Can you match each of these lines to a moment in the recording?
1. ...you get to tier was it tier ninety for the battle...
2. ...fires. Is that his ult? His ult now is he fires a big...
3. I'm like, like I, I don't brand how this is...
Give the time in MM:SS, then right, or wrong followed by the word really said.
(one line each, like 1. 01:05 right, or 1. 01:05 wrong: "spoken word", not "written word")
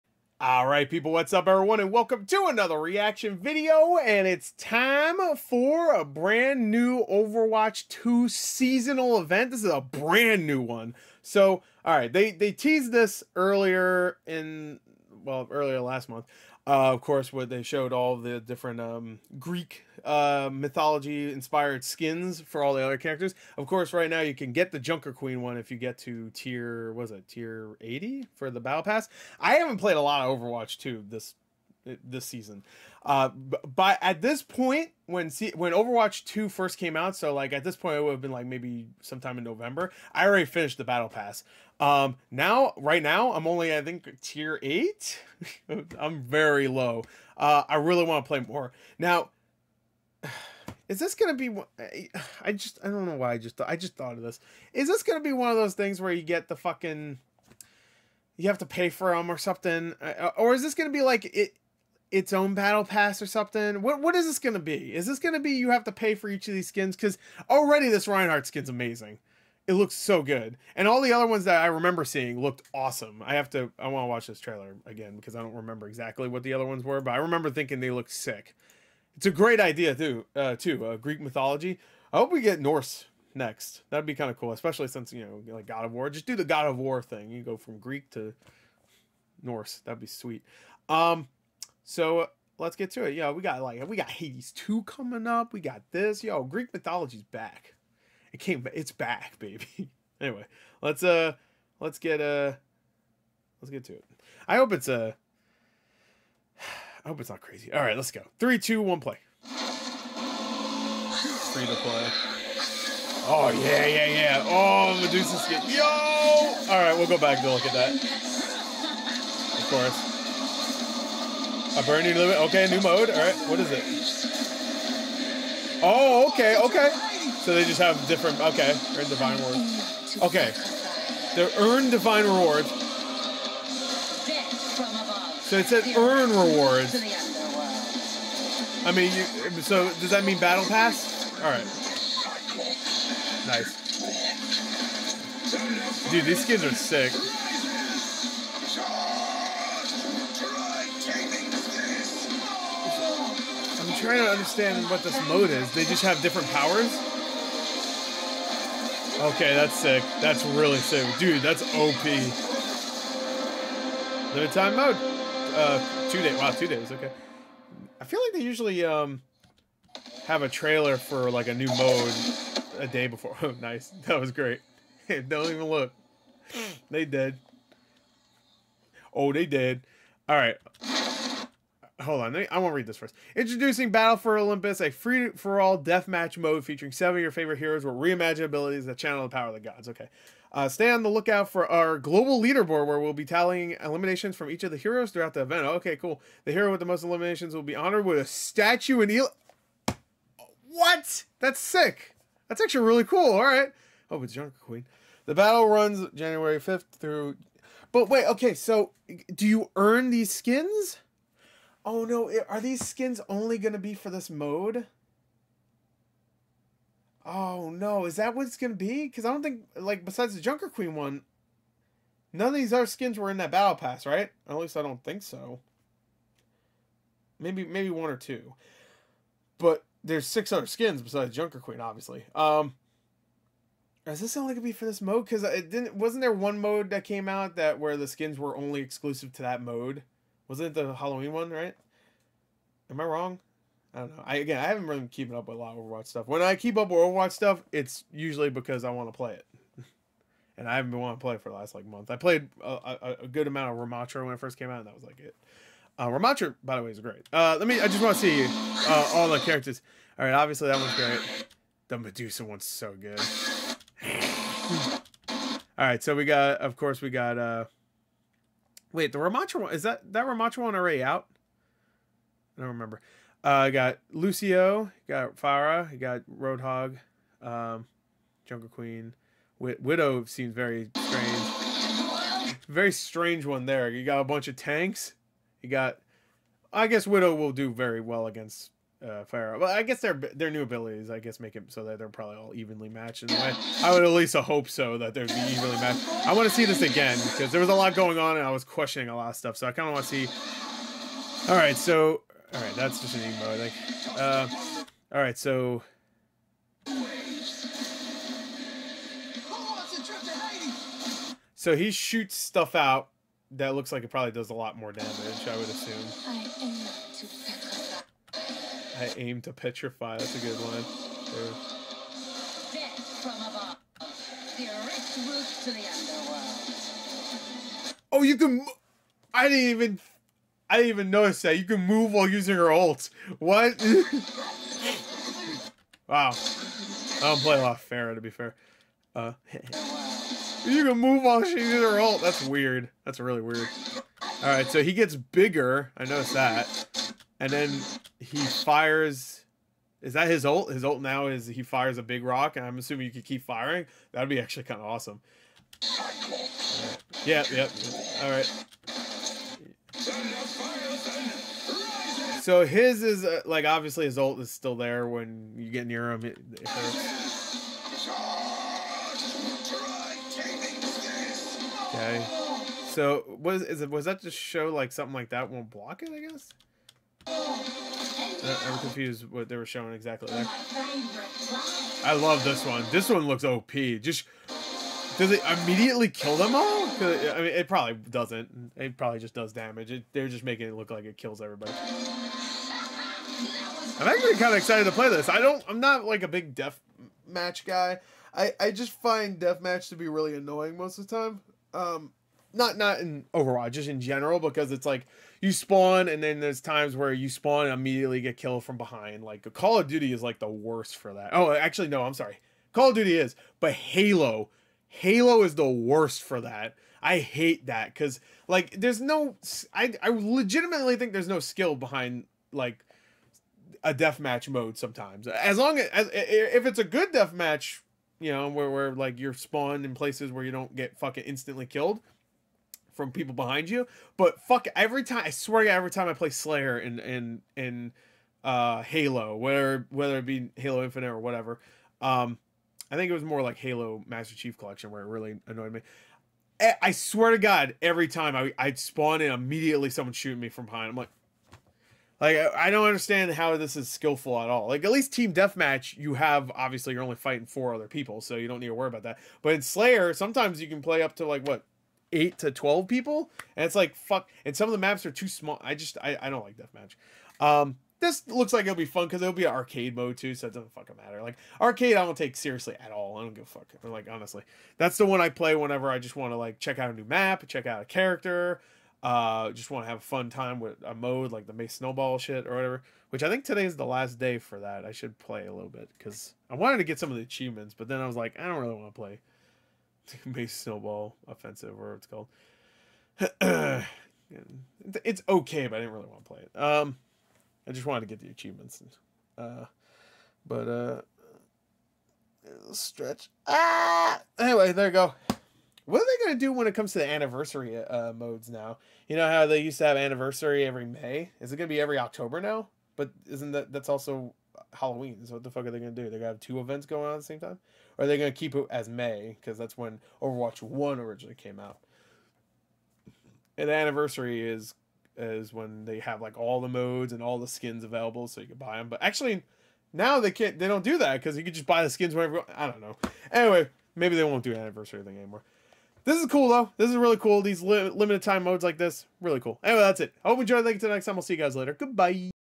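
1. 00:25 wrong: "eighty", not "ninety"
2. 05:48 right
3. 07:30 wrong: "understand", not "brand".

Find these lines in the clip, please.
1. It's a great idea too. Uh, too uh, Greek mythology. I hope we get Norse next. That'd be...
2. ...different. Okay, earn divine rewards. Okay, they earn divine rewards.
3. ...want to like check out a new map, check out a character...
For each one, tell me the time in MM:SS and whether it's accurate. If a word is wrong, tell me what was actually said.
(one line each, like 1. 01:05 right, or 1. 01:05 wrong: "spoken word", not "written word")
1. 01:19 right
2. 02:08 right
3. 07:56 right.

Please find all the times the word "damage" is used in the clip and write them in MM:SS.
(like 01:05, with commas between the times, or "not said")
05:14, 06:29.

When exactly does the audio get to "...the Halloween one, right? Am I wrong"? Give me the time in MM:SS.
04:00.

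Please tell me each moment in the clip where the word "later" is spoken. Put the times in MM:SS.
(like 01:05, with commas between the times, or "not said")
09:01.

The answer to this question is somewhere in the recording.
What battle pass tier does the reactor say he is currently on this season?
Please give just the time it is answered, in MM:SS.
00:44.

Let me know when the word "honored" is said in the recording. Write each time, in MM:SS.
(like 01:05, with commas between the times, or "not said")
03:17.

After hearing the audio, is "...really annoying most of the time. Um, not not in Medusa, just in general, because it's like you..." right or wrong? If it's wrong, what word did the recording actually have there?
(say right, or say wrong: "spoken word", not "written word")
wrong: "Overwatch", not "Medusa".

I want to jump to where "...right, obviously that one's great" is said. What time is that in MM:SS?
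04:20.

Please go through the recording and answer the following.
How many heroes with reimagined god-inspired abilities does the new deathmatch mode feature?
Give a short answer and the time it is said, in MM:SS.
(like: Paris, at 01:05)
7, at 03:06.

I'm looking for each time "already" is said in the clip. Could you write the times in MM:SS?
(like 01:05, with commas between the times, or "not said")
00:40, 01:07, 04:30.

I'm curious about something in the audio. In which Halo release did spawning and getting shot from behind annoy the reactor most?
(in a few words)
Master Chief Collection.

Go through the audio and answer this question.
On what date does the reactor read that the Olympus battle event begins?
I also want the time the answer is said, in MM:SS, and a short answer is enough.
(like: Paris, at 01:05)
January 5th, at 03:26.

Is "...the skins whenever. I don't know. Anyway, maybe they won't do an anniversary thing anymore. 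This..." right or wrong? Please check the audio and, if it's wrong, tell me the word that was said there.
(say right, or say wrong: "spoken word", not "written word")
right.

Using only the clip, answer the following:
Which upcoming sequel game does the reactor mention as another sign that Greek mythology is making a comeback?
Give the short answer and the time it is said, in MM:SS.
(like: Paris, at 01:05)
Hades 2, at 01:34.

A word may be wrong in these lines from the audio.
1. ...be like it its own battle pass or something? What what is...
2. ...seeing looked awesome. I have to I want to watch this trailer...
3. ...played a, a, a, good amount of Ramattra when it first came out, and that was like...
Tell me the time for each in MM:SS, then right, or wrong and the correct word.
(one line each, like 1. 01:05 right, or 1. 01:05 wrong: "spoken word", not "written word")
1. 01:00 right
2. 01:12 right
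3. 04:12 right.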